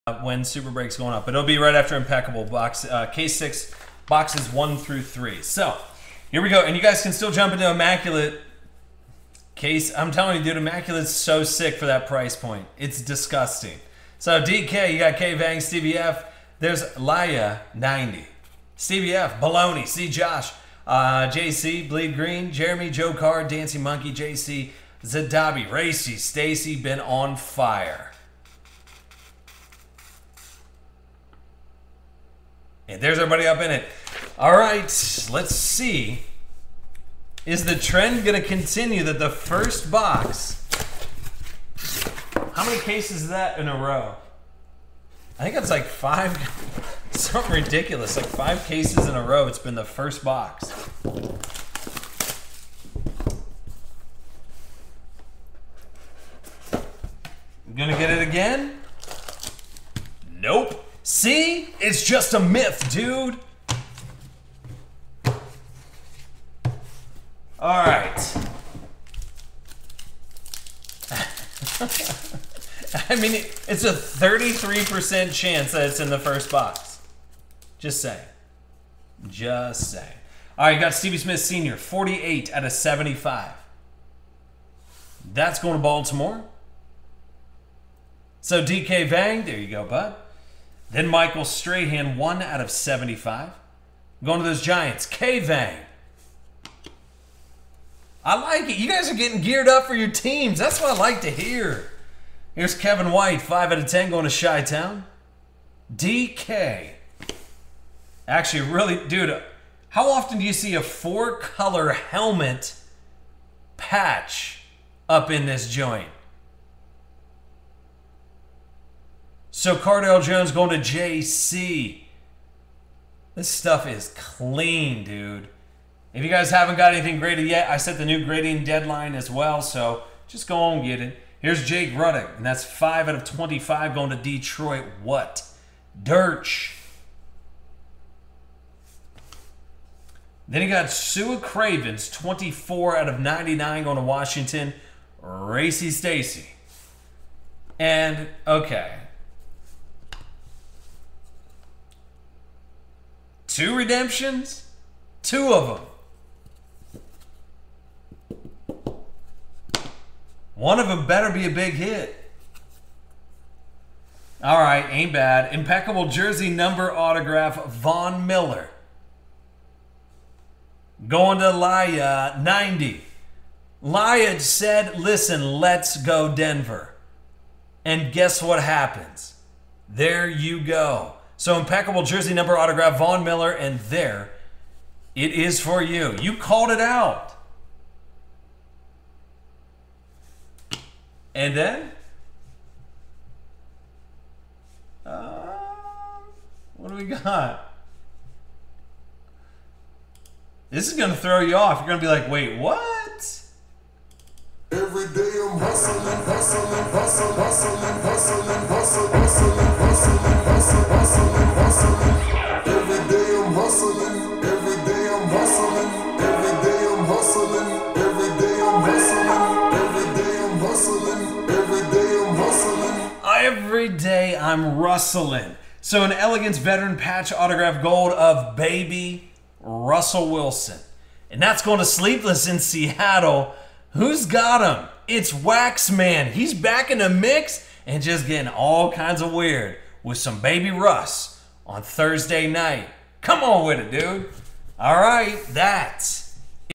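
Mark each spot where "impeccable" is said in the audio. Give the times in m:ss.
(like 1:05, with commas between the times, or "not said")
0:01, 2:45, 3:01.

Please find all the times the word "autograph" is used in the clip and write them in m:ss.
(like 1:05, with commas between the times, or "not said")
2:46, 3:02, 3:47.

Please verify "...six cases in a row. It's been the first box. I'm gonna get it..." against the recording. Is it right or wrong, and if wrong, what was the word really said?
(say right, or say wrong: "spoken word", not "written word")
wrong: "five", not "six".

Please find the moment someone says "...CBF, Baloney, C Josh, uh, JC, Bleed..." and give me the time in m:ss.
0:18.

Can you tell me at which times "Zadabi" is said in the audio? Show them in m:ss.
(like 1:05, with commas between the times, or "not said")
0:25.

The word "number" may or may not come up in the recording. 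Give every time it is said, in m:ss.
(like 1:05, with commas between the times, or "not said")
2:46, 3:02.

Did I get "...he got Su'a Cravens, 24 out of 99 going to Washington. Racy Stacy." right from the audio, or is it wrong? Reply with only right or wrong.
right.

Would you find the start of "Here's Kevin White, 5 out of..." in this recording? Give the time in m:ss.
1:42.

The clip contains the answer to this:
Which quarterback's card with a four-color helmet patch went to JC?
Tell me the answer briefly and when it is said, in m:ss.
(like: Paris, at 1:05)
Cardale Jones, at 1:59.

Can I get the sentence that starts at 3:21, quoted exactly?
You're going to be like, wait, what?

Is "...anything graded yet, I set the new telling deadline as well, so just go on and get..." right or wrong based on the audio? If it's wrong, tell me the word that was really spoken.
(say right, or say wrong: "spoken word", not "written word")
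wrong: "grading", not "telling".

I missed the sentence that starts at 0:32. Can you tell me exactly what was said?
And there's everybody up in it.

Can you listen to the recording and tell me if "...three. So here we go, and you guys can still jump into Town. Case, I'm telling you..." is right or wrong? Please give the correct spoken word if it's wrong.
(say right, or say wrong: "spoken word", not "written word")
wrong: "Immaculate", not "Town".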